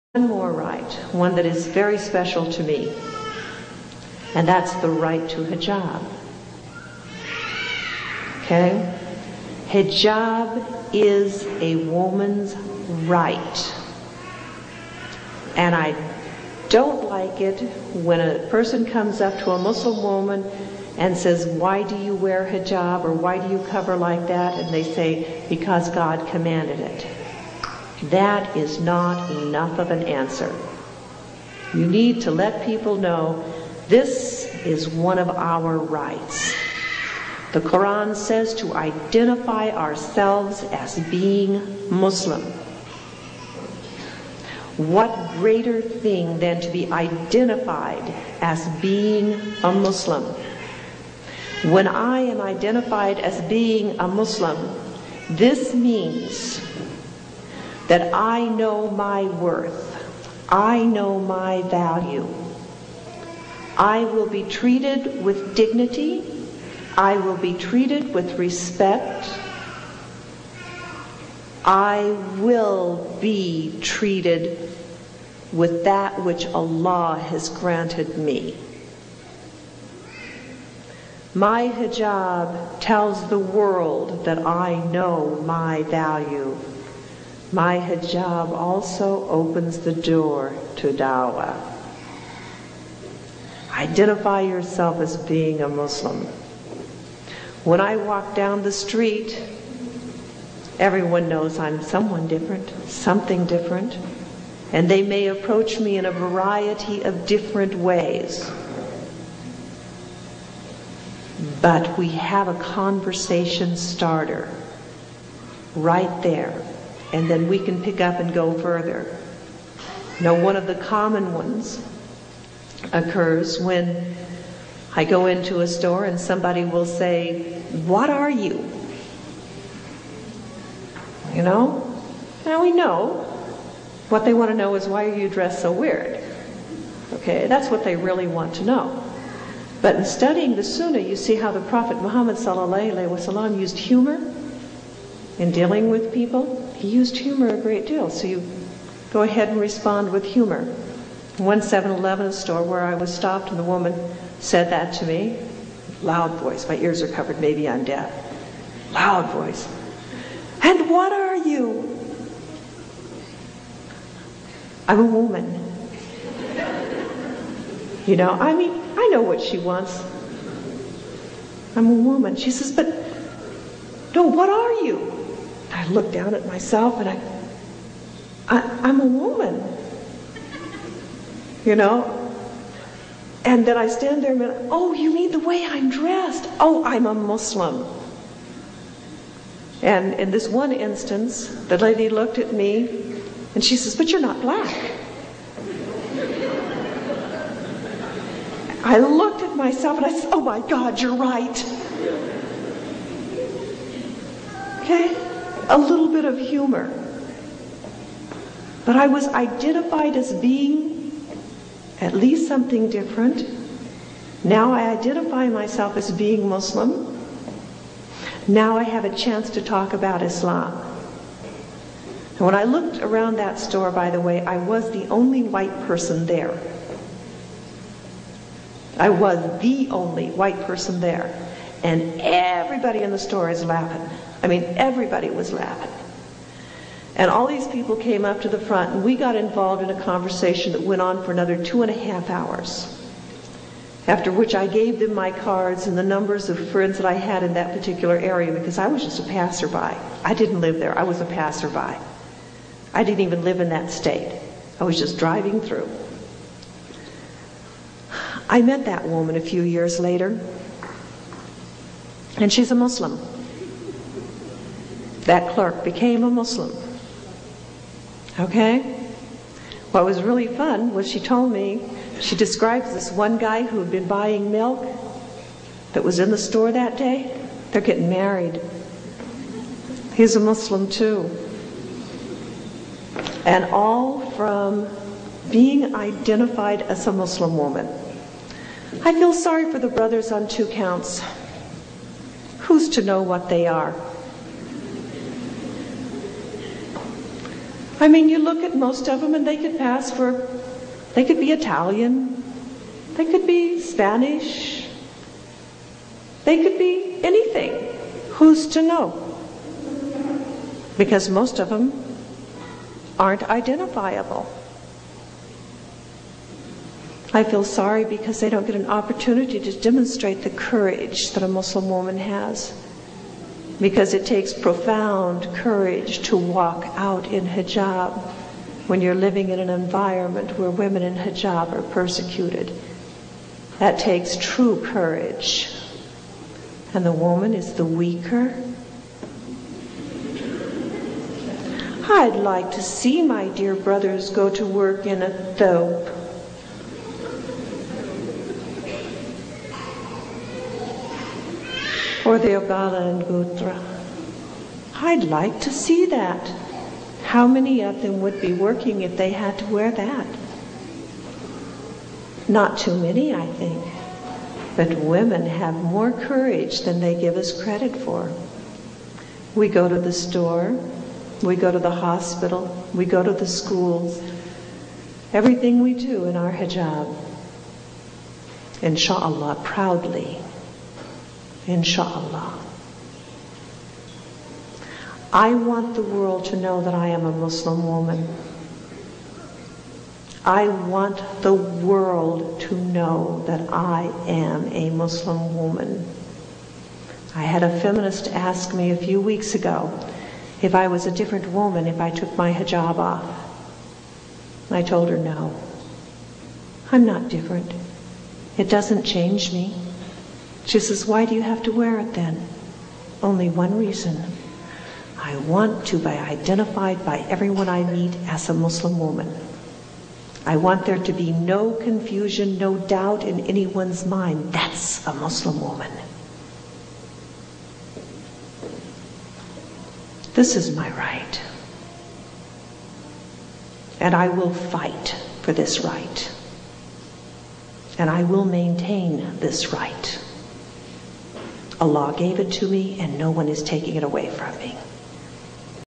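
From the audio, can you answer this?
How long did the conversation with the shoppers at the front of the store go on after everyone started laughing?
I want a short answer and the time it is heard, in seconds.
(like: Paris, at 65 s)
2 and a half hours, at 241 s.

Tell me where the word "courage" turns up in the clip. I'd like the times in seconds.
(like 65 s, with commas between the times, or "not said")
320 s, 325 s, 334 s, 366 s.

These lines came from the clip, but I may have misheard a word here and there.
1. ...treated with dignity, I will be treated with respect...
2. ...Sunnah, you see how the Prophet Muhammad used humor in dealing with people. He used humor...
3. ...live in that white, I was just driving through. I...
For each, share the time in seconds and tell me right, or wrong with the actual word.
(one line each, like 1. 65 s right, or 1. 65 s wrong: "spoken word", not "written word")
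1. 64 s right
2. 140 s right
3. 253 s wrong: "state", not "white".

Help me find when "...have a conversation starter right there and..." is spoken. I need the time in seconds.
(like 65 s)
112 s.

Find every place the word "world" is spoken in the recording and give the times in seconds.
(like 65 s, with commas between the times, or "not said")
83 s, 386 s, 391 s.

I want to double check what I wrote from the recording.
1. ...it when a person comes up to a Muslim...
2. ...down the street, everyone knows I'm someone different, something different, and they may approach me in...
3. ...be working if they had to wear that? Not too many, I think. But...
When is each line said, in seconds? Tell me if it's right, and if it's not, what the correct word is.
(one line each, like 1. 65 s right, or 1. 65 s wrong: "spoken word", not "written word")
1. 17 s right
2. 98 s right
3. 358 s right.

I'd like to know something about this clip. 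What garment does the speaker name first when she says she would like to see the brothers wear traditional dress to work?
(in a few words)
Thobe.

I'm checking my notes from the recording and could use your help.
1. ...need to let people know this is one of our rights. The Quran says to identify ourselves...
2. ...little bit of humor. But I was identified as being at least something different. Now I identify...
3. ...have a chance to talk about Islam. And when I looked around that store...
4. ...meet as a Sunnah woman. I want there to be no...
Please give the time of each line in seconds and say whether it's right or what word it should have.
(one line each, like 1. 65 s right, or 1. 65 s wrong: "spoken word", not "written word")
1. 31 s right
2. 205 s right
3. 218 s right
4. 417 s wrong: "Muslim", not "Sunnah".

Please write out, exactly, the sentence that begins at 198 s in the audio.
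I looked at myself and I said, Oh my God, you're right.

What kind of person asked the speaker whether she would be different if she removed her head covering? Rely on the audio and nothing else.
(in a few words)
A feminist.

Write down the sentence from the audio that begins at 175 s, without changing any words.
I looked down at myself and I, I am a woman.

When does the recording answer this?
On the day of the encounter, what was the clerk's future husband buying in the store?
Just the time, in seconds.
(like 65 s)
274 s.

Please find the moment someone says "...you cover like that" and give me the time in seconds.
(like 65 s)
23 s.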